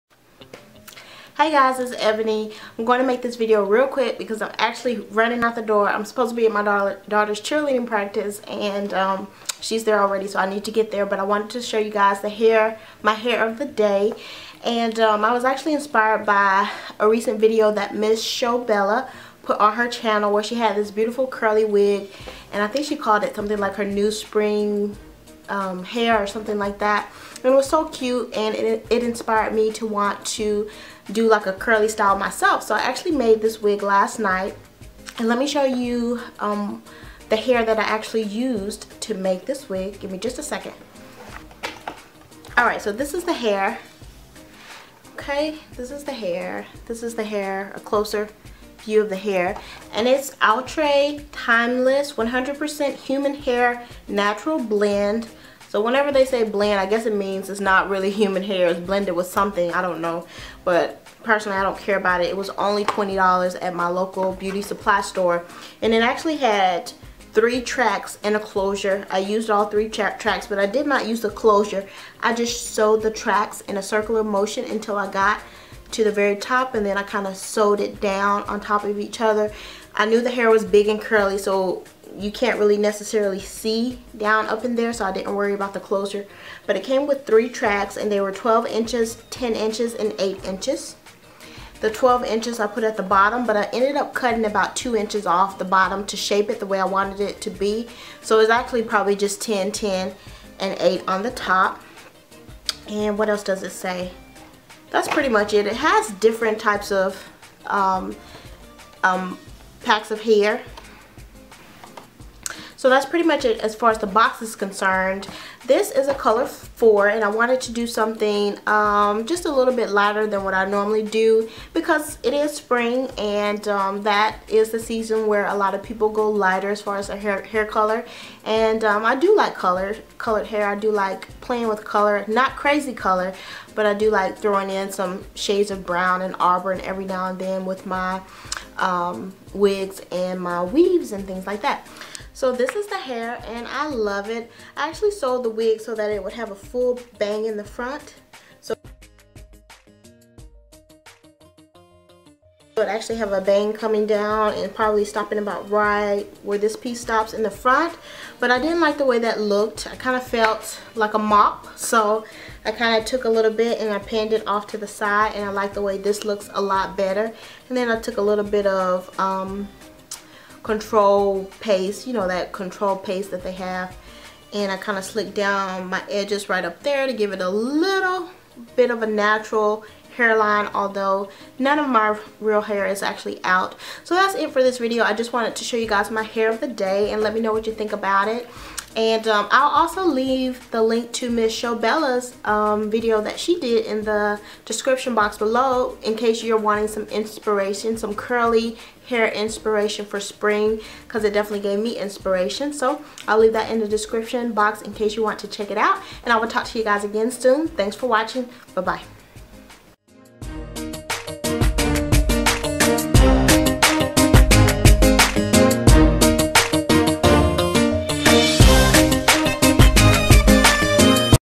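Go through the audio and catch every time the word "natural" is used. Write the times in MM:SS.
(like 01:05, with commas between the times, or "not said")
00:54, 02:59.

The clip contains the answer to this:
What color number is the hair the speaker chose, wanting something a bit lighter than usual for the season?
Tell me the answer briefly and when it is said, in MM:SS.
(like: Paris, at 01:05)
4, at 01:56.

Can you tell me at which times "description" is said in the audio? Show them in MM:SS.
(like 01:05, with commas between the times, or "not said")
03:14, 03:23.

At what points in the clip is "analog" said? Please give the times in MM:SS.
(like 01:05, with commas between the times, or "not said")
not said.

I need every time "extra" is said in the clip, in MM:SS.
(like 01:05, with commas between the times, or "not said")
not said.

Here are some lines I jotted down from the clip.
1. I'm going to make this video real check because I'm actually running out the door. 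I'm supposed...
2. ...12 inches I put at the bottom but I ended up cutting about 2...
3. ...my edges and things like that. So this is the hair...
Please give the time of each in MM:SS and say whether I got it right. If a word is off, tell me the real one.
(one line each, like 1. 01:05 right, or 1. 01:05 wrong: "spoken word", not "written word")
1. 00:02 wrong: "quick", not "check"
2. 01:31 right
3. 02:20 wrong: "weaves", not "edges".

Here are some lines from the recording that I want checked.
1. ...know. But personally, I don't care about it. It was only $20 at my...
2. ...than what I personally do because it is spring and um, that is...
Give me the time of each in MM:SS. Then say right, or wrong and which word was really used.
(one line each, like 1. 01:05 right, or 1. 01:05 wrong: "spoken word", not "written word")
1. 01:00 right
2. 02:00 wrong: "normally", not "personally".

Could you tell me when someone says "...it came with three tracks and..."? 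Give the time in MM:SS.
01:26.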